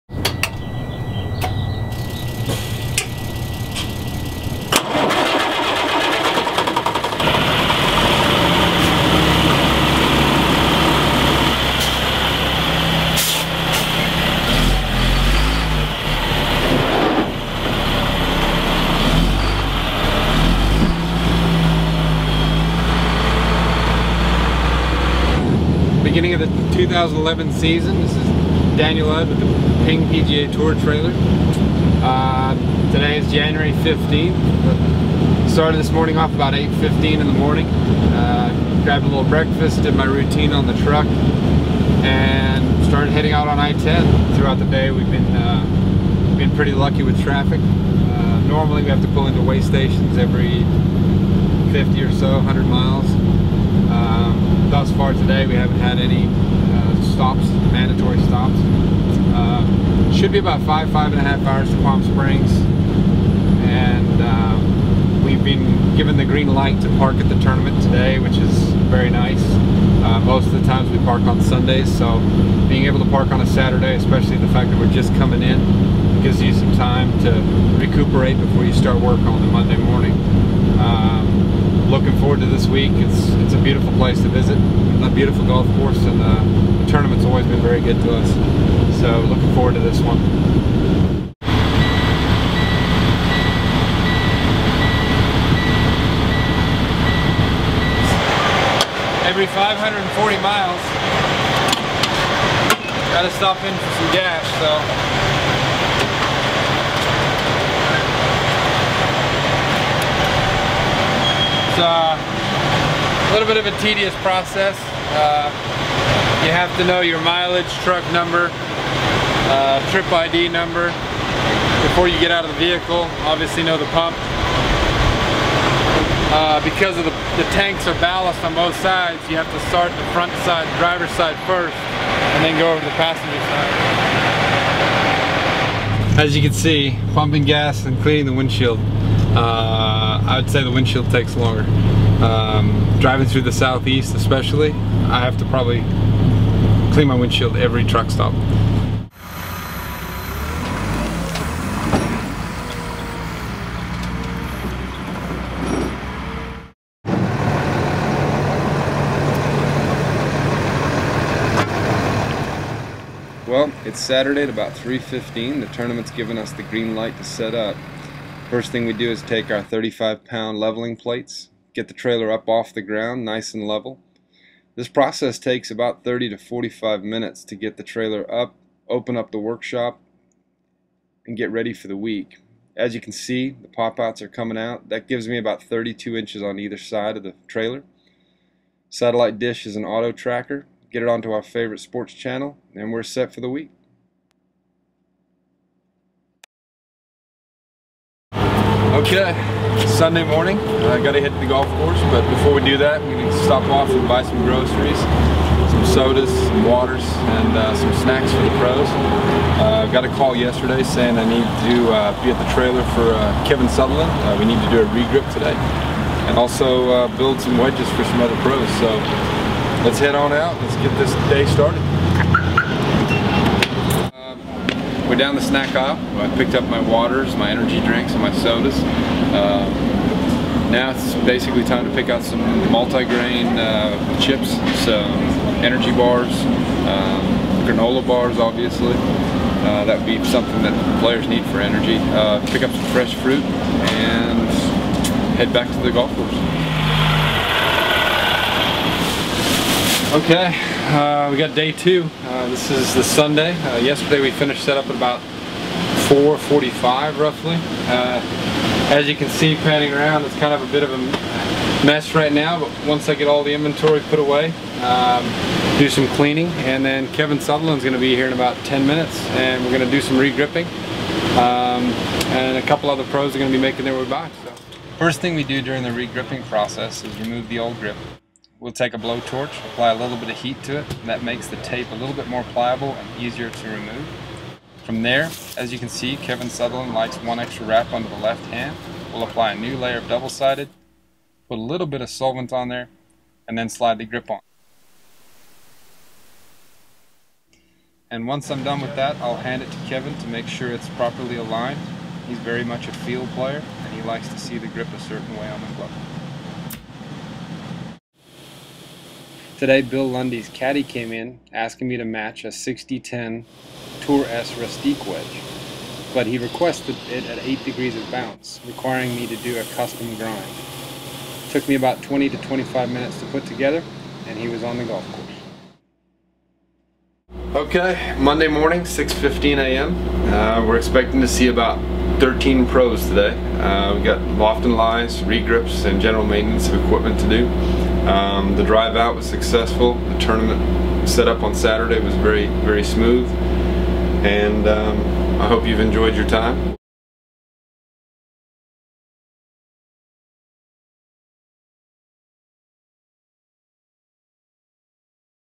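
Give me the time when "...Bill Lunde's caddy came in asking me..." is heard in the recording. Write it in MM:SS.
05:09.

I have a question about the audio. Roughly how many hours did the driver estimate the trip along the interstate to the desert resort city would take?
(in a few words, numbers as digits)
5 and a half hours.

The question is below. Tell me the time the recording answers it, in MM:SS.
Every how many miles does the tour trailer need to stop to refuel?
01:39.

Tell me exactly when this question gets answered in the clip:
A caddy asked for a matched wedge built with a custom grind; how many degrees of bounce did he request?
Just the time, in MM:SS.
05:17.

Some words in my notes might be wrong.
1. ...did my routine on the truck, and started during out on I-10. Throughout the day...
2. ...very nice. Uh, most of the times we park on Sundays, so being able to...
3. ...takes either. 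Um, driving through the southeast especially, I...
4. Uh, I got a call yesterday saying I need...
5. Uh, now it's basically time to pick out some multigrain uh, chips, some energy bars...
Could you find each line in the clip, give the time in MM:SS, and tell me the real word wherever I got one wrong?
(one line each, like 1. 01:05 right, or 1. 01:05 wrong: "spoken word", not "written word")
1. 00:39 wrong: "heading", not "during"
2. 01:08 right
3. 02:21 wrong: "longer", not "either"
4. 03:29 right
5. 03:48 right.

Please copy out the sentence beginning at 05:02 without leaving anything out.
He's very much a field player, and he likes to see the grip a certain way on the glove.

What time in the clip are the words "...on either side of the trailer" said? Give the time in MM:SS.
03:06.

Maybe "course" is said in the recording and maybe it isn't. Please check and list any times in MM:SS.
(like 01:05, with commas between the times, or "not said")
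01:25, 03:21, 04:06, 05:25.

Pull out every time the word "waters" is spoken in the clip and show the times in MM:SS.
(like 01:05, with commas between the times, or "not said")
03:26, 03:46.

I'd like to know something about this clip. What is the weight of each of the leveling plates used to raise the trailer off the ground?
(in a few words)
35 pounds.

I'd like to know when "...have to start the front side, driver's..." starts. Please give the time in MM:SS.
02:09.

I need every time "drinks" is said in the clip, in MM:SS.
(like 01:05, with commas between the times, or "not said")
03:47.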